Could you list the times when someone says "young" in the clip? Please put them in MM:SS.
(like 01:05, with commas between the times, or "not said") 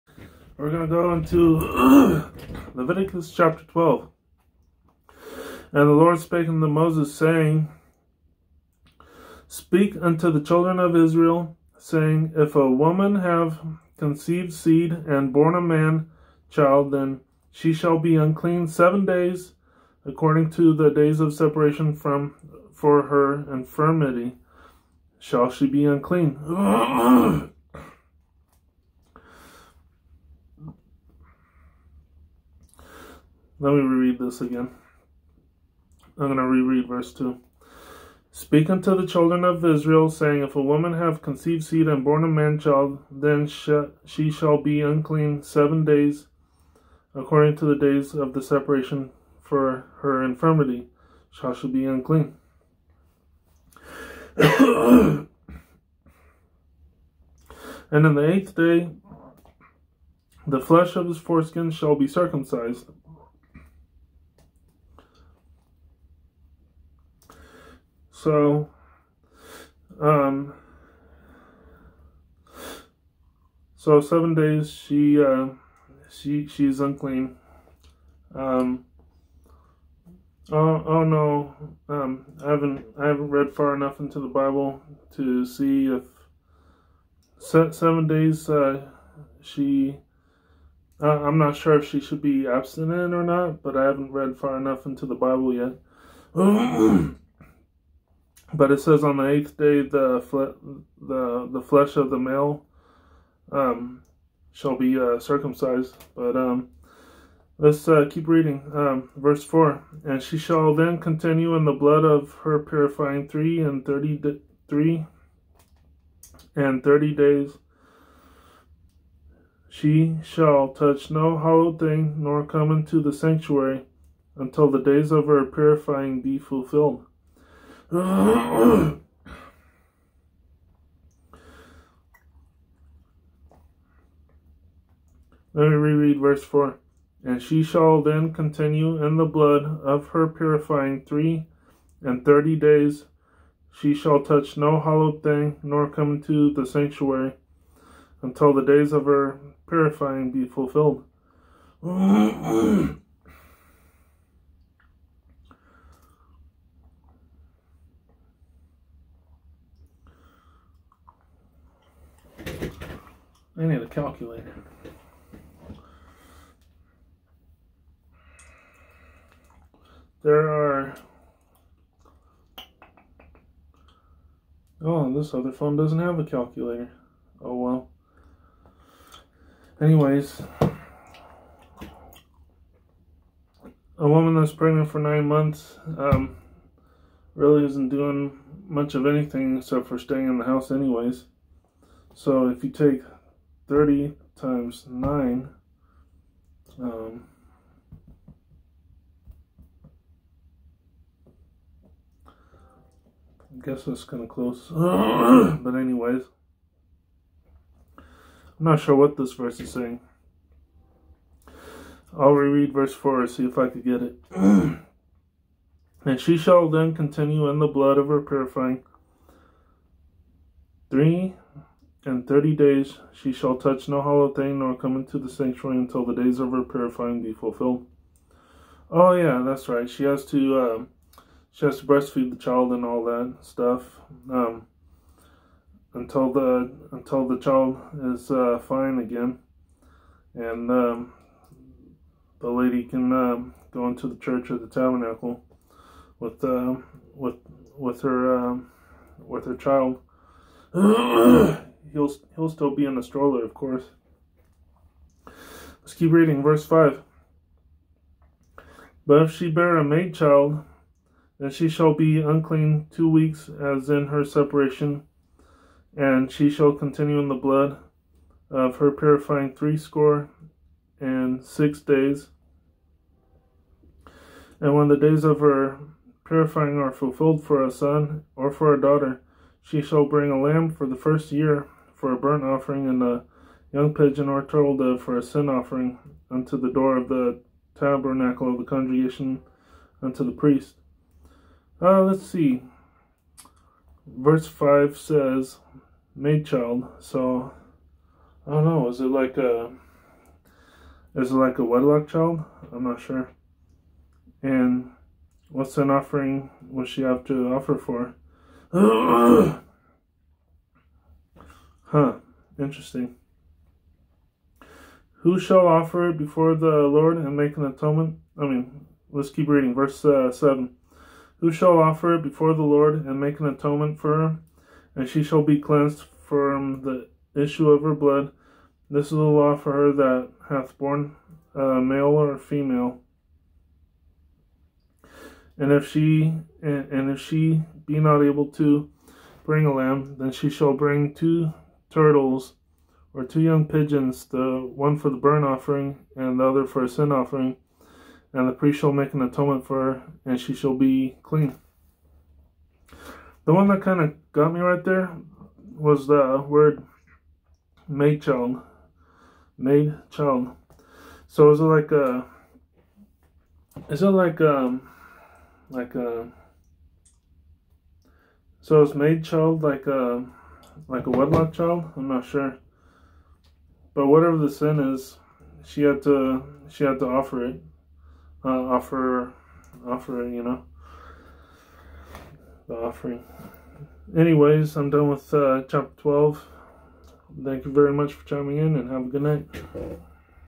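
04:43, 05:43.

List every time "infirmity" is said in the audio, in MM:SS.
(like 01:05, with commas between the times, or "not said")
00:23, 00:50.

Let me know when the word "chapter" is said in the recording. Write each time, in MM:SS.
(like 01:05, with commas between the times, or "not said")
00:03, 06:25.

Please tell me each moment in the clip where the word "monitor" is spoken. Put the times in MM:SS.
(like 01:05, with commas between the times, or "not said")
not said.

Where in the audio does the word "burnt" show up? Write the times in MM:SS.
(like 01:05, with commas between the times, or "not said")
04:42, 05:45.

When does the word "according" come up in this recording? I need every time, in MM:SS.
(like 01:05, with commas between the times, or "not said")
00:20, 00:47.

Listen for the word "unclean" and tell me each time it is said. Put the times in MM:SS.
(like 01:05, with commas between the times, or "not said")
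00:18, 00:25, 00:44, 00:51, 01:16, 04:22.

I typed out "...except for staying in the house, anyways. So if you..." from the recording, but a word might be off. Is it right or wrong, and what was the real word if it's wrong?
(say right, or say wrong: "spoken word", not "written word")
right.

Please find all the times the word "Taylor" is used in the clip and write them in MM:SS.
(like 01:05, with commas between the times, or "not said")
not said.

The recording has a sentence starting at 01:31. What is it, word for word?
Uh, I'm not sure if she should be abstinent or not, but I haven't read far enough into the Bible yet.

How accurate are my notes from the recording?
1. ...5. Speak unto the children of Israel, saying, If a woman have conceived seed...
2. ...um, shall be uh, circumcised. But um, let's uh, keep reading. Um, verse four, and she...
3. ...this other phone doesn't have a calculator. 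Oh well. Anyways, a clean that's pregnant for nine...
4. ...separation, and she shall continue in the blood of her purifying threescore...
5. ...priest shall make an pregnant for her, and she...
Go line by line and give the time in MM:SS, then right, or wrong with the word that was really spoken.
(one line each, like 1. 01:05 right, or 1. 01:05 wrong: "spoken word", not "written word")
1. 00:37 wrong: "2", not "5"
2. 01:43 right
3. 02:55 wrong: "woman", not "clean"
4. 04:24 right
5. 05:48 wrong: "atonement", not "pregnant".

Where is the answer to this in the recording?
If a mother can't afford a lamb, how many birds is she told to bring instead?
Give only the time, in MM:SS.
05:41.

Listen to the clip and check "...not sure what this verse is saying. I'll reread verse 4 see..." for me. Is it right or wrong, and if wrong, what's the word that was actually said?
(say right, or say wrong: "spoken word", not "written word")
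right.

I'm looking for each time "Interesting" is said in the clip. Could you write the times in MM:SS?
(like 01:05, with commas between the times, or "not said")
05:12.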